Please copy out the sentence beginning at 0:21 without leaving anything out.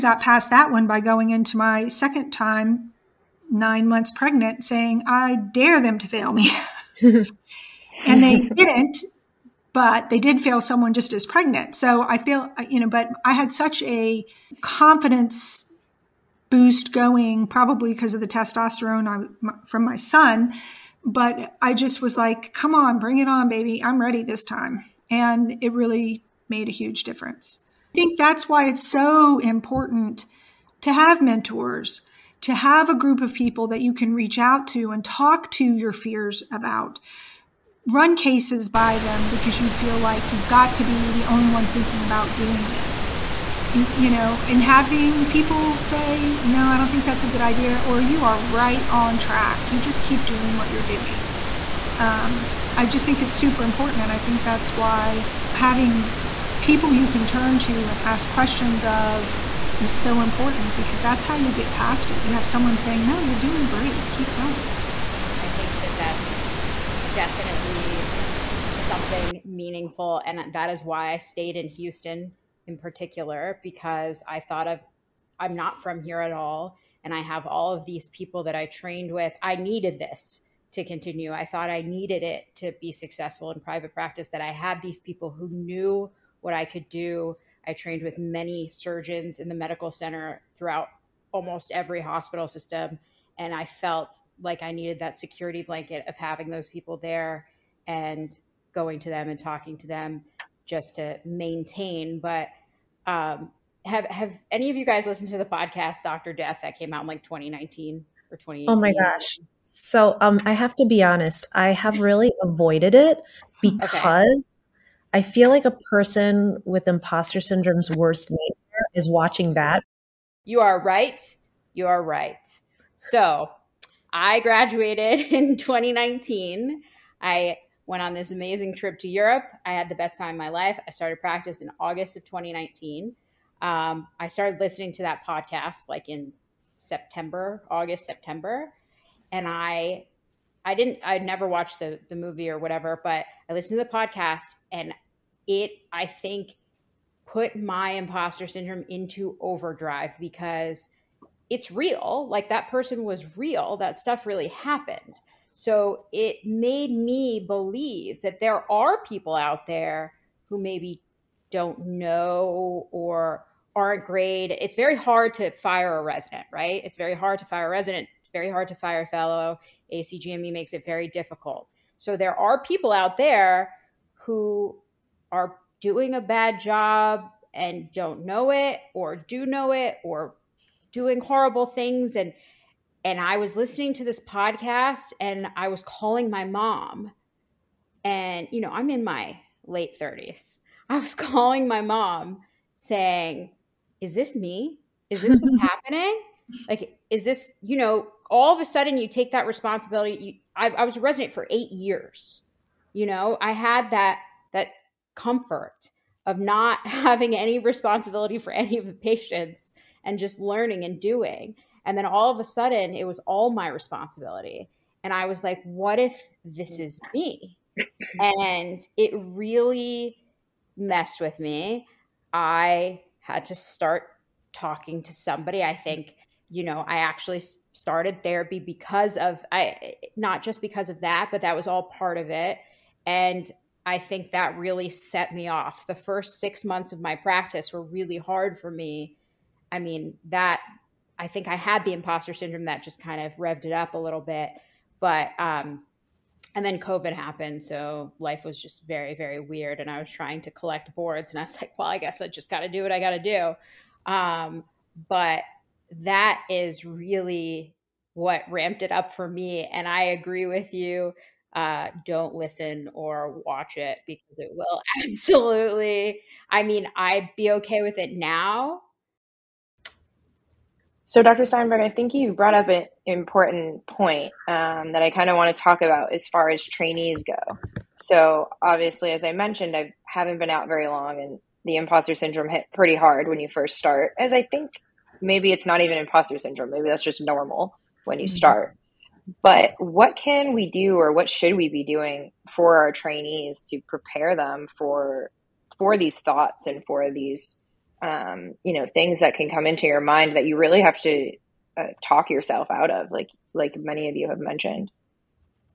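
But I just was like, come on, bring it on, baby.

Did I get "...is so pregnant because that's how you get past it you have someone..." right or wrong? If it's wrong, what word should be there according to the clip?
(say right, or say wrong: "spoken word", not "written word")
wrong: "important", not "pregnant".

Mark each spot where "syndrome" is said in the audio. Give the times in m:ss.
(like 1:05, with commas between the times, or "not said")
1:57, 2:28, 4:02, 4:42, 4:46.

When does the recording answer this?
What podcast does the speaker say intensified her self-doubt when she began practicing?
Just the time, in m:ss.
1:46.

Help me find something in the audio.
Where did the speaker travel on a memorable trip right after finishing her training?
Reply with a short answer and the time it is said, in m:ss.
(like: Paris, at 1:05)
Europe, at 2:09.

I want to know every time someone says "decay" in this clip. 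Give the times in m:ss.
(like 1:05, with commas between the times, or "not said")
not said.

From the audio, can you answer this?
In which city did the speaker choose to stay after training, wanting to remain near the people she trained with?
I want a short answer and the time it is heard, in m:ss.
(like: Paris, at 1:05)
Houston, at 1:11.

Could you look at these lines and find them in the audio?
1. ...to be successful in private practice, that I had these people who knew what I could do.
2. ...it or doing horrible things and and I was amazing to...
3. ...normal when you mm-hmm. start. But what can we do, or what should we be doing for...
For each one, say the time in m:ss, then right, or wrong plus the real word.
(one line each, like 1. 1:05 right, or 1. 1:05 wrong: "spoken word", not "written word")
1. 1:22 right
2. 2:59 wrong: "listening", not "amazing"
3. 4:47 right.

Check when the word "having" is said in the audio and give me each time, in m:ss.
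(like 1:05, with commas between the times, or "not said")
0:44, 0:55, 1:36, 3:26.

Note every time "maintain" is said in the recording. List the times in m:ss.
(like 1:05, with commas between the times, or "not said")
1:41.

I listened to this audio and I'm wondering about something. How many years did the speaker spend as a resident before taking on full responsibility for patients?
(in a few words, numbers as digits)
8.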